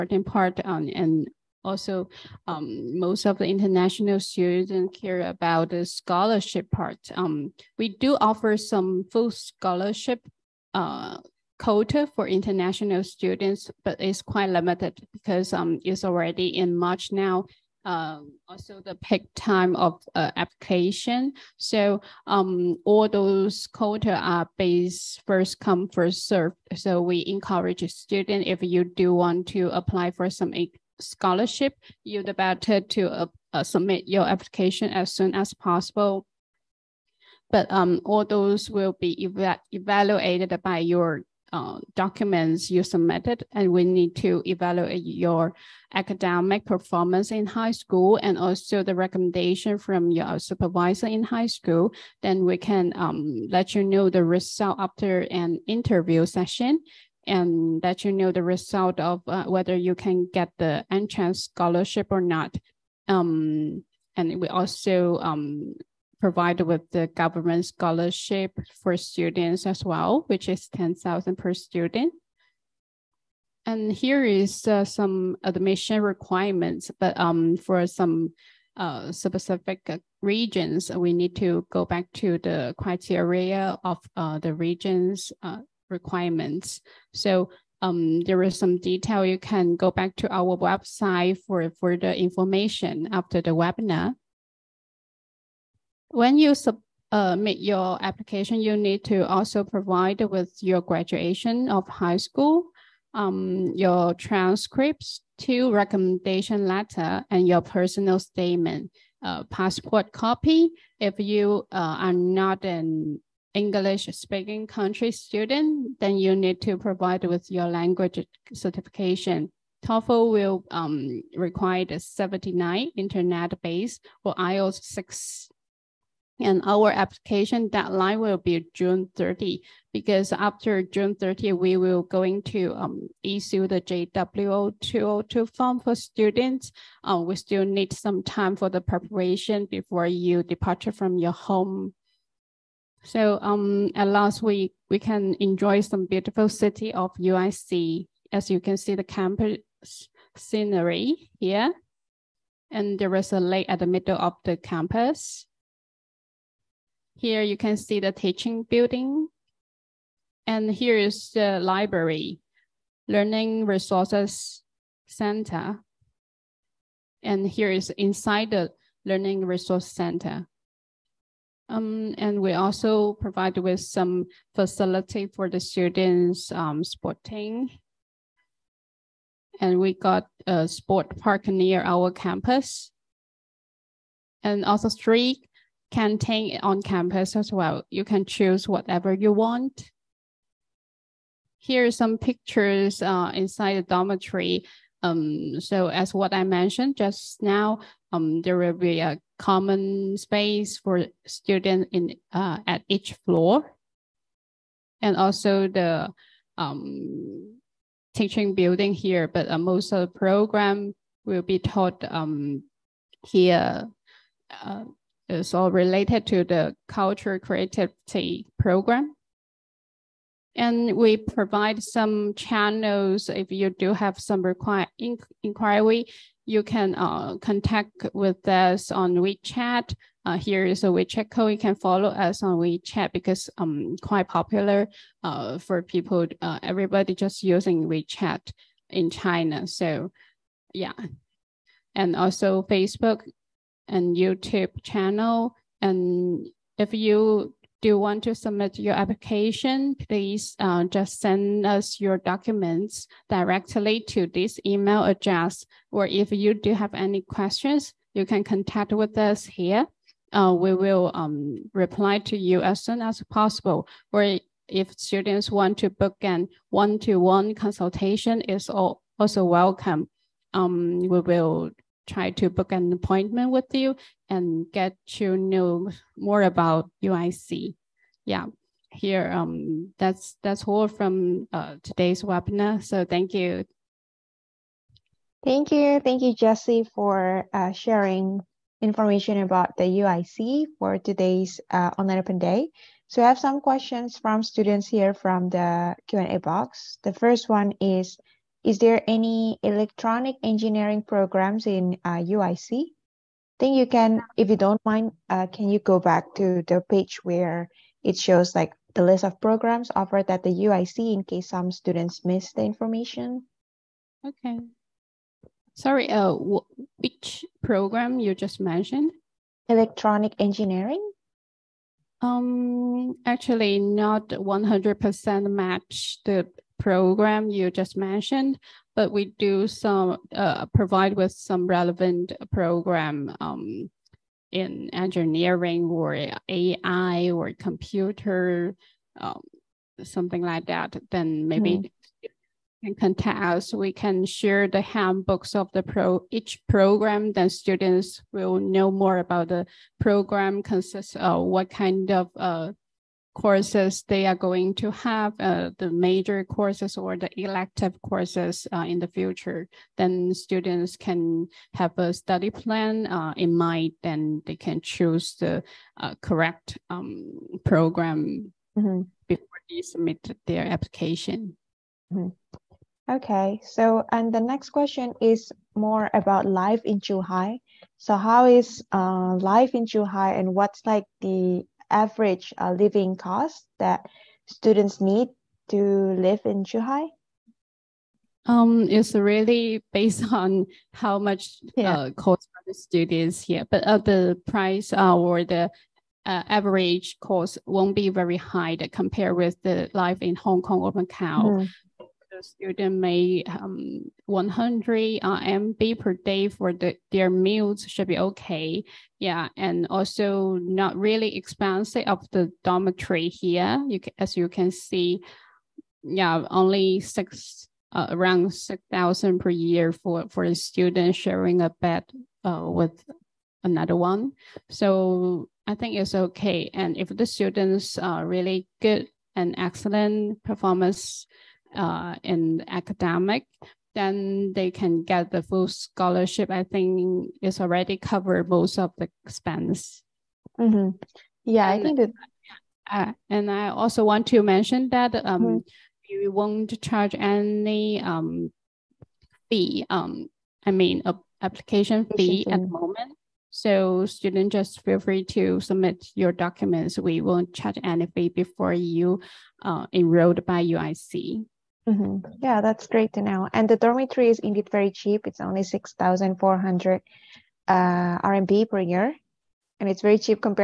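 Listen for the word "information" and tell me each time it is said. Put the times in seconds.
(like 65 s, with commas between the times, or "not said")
92 s, 288 s, 312 s.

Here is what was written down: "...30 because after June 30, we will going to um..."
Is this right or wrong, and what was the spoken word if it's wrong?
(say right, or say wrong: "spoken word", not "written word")
right.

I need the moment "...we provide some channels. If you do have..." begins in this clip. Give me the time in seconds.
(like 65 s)
220 s.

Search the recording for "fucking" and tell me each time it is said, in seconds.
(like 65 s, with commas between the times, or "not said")
not said.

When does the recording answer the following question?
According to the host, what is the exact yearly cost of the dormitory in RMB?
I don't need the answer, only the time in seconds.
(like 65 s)
465 s.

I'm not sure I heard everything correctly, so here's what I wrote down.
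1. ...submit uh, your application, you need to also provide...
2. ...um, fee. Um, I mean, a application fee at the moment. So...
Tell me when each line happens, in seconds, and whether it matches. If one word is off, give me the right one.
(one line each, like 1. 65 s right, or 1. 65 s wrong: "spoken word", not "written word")
1. 96 s right
2. 448 s right.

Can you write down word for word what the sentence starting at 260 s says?
Uh, we will um, reply to you as soon as possible.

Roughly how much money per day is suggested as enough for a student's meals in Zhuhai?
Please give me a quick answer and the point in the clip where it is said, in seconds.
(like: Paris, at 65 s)
100 RMB, at 404 s.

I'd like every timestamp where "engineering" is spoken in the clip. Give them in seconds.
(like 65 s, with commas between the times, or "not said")
300 s, 320 s, 334 s.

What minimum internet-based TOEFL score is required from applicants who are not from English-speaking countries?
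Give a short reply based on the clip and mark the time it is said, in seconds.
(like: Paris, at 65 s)
79, at 121 s.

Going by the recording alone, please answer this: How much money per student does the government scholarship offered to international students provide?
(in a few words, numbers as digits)
10,000.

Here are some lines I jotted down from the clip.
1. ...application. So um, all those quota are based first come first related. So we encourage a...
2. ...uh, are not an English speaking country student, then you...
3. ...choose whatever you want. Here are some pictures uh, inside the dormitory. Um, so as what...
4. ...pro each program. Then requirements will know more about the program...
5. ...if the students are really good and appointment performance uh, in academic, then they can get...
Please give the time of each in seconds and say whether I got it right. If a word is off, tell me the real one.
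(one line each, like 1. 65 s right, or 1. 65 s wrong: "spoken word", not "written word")
1. 20 s wrong: "served", not "related"
2. 111 s right
3. 188 s right
4. 345 s wrong: "students", not "requirements"
5. 426 s wrong: "excellent", not "appointment".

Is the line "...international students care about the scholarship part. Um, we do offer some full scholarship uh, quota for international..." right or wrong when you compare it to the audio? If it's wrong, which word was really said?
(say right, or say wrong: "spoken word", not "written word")
right.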